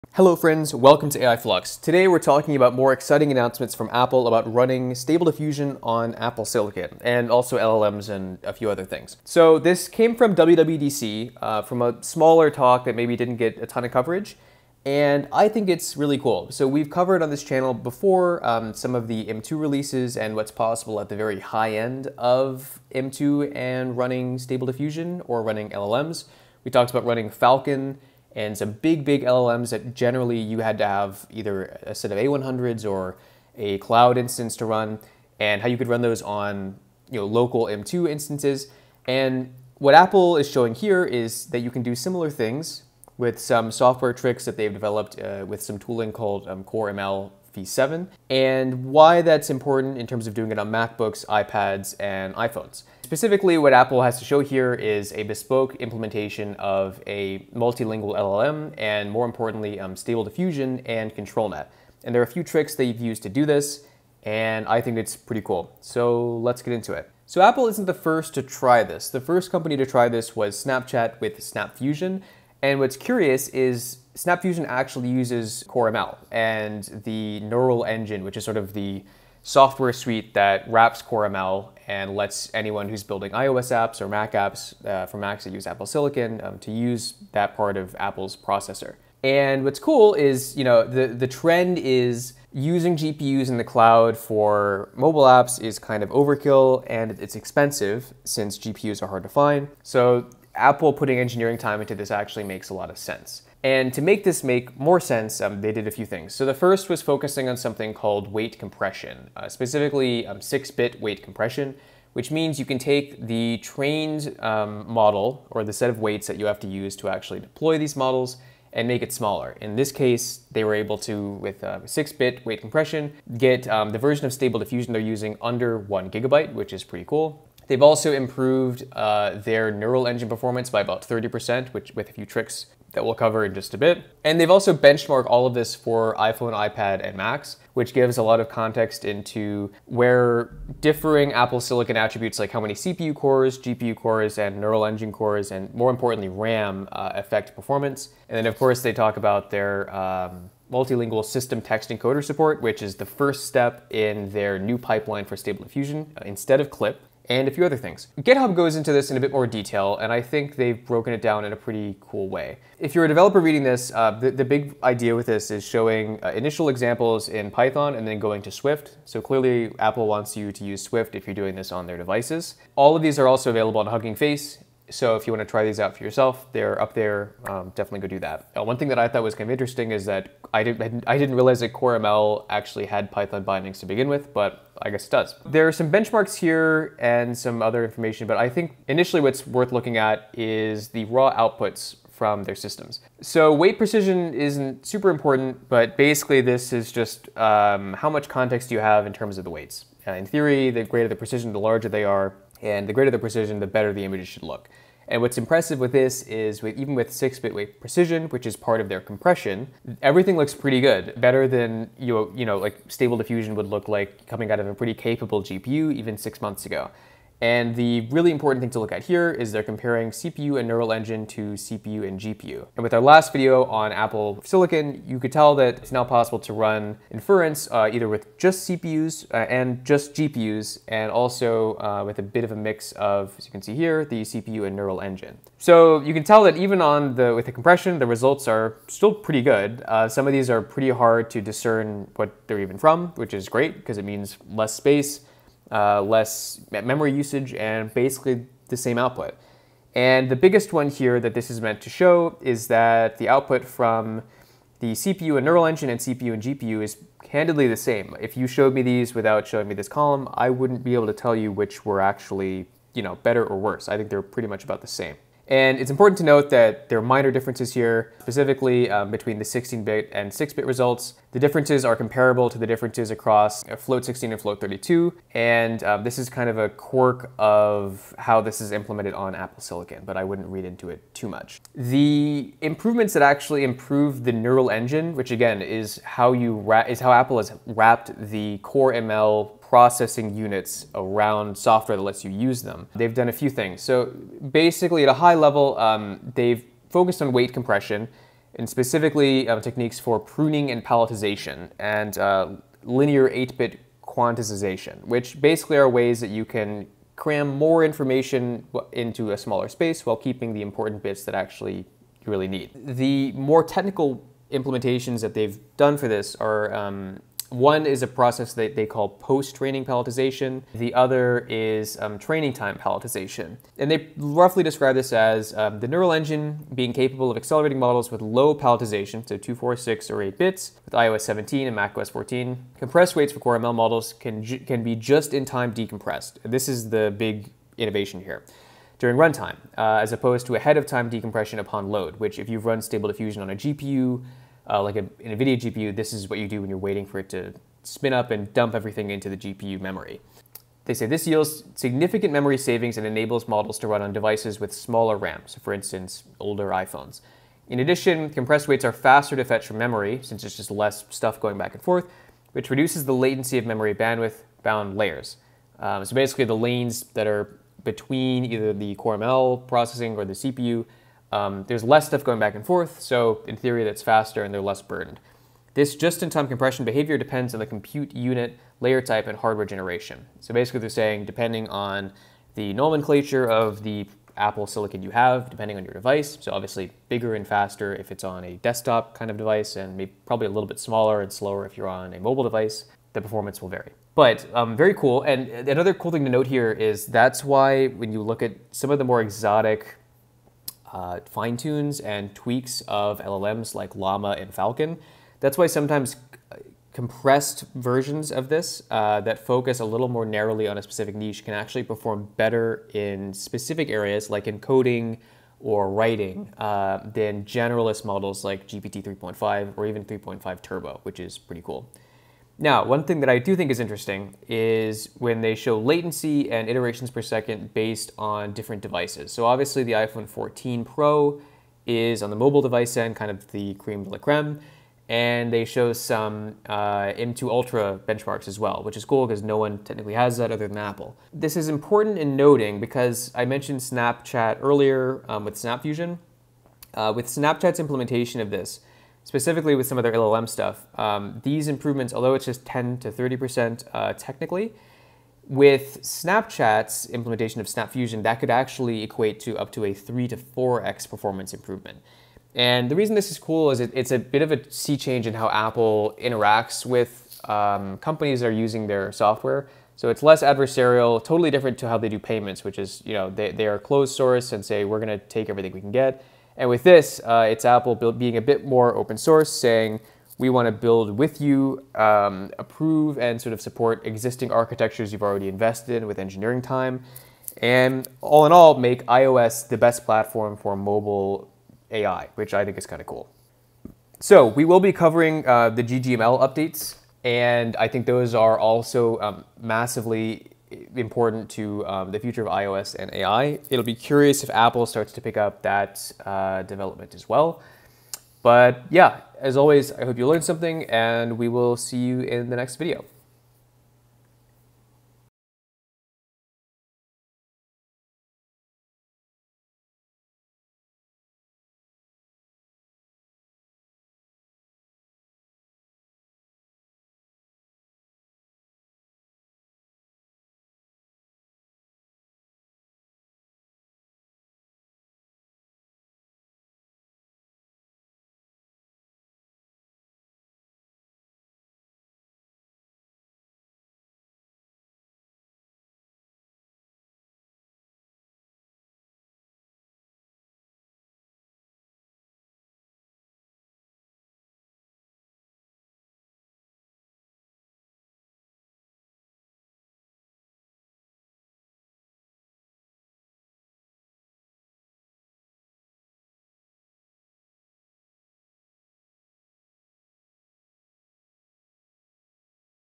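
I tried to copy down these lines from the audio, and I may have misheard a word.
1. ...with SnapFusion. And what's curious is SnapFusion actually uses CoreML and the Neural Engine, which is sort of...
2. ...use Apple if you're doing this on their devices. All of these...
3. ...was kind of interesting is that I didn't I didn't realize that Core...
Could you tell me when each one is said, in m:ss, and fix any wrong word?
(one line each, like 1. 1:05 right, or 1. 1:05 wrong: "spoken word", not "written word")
1. 1:11 right
2. 2:50 wrong: "Swift", not "Apple"
3. 2:59 right.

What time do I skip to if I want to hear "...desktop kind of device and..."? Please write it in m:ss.
6:28.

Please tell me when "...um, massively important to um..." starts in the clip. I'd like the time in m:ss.
8:19.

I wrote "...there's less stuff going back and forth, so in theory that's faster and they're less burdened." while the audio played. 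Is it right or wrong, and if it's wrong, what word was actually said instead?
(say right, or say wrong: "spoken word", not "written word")
right.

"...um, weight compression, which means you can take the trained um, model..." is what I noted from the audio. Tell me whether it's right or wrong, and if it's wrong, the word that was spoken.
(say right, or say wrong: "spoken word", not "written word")
right.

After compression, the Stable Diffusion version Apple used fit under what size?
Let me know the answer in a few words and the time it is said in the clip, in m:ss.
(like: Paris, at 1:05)
1 gigabyte, at 2:05.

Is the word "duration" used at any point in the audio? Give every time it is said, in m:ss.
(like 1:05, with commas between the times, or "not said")
not said.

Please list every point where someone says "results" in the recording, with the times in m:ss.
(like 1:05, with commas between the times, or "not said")
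3:58, 4:30.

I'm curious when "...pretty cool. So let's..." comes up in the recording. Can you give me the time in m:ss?
1:05.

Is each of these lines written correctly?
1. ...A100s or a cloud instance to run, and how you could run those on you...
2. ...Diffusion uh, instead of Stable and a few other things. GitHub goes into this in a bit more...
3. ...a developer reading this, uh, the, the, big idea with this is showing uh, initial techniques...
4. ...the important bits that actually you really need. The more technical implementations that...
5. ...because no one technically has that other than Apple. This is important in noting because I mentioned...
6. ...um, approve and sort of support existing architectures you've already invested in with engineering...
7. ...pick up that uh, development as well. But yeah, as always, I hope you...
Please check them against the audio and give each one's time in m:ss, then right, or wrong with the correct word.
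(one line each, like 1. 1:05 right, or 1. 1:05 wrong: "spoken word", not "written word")
1. 0:32 right
2. 2:35 wrong: "Clip", not "Stable"
3. 2:43 wrong: "examples", not "techniques"
4. 5:10 right
5. 7:19 right
6. 8:01 right
7. 8:25 right.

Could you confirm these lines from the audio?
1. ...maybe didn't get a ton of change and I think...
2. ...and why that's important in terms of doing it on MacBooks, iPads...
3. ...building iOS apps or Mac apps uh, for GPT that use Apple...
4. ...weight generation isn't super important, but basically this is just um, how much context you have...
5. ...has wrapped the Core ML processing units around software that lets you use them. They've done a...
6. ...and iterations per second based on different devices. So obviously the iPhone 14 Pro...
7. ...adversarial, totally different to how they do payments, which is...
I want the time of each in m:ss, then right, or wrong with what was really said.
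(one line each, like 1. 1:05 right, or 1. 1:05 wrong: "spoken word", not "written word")
1. 0:12 wrong: "coverage", not "change"
2. 0:48 right
3. 1:23 wrong: "Macs", not "GPT"
4. 3:13 wrong: "precision", not "generation"
5. 4:47 right
6. 7:06 right
7. 7:50 right.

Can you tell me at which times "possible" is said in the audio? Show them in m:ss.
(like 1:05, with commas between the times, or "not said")
0:20, 3:46.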